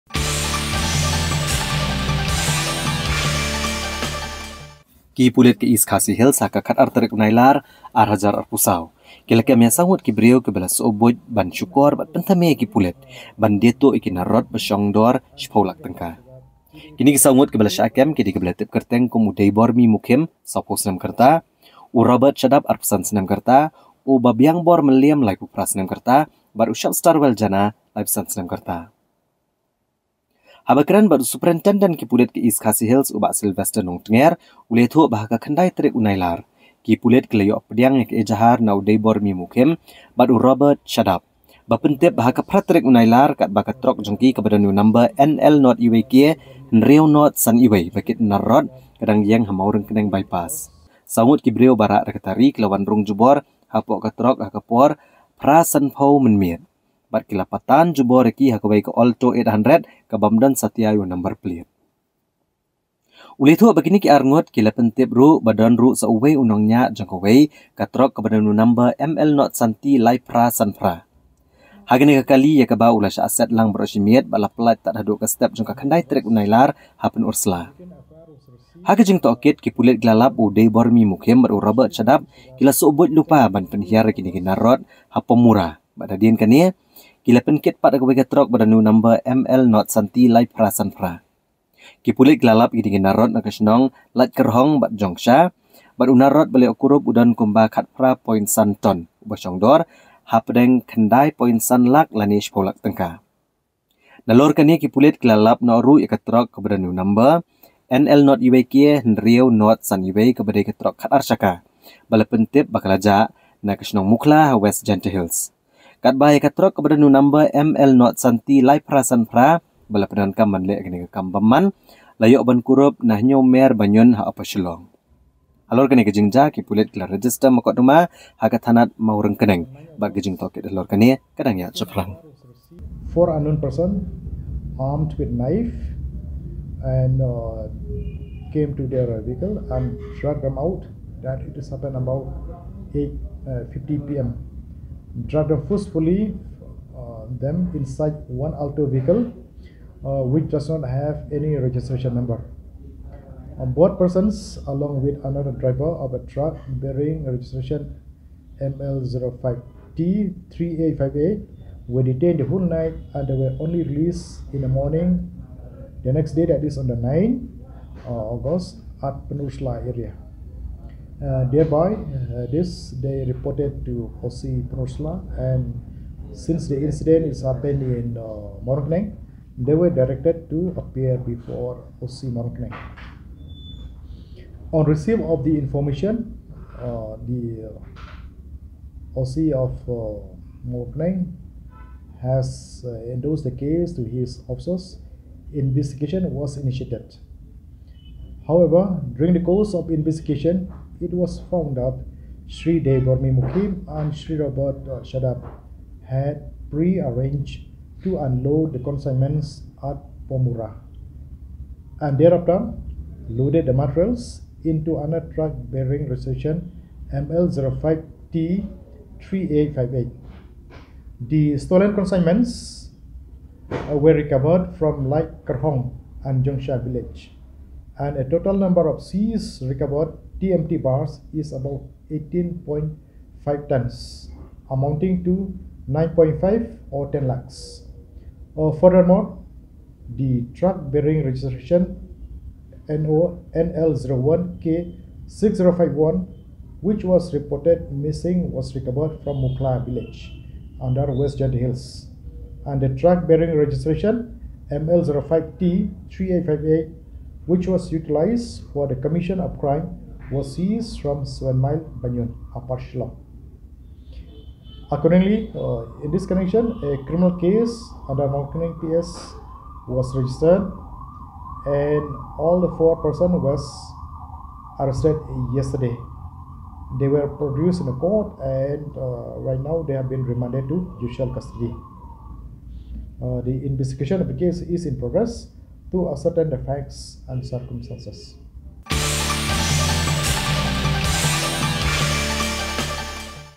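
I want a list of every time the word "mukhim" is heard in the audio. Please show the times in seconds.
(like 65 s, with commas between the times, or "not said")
19 s, 81 s.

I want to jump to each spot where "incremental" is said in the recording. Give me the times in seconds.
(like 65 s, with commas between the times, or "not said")
not said.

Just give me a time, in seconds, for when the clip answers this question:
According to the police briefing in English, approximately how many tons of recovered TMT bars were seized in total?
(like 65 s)
232 s.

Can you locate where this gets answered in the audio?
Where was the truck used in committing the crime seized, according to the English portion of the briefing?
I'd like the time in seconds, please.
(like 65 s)
261 s.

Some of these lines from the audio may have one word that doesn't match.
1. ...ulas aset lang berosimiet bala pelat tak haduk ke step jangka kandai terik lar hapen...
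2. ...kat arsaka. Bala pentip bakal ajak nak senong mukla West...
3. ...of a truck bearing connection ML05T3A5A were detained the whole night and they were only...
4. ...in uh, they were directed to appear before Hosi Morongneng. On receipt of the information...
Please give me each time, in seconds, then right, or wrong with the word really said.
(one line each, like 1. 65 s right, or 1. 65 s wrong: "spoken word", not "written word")
1. 72 s right
2. 110 s right
3. 155 s wrong: "registration", not "connection"
4. 177 s right.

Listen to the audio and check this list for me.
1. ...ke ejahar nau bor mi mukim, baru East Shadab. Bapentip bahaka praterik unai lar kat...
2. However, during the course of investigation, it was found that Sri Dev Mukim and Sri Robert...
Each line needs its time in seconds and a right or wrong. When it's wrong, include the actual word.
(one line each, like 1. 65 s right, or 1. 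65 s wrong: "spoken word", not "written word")
1. 38 s wrong: "Robert", not "East"
2. 198 s right.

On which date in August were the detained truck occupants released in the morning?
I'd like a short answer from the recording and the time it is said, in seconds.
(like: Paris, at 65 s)
9th August, at 166 s.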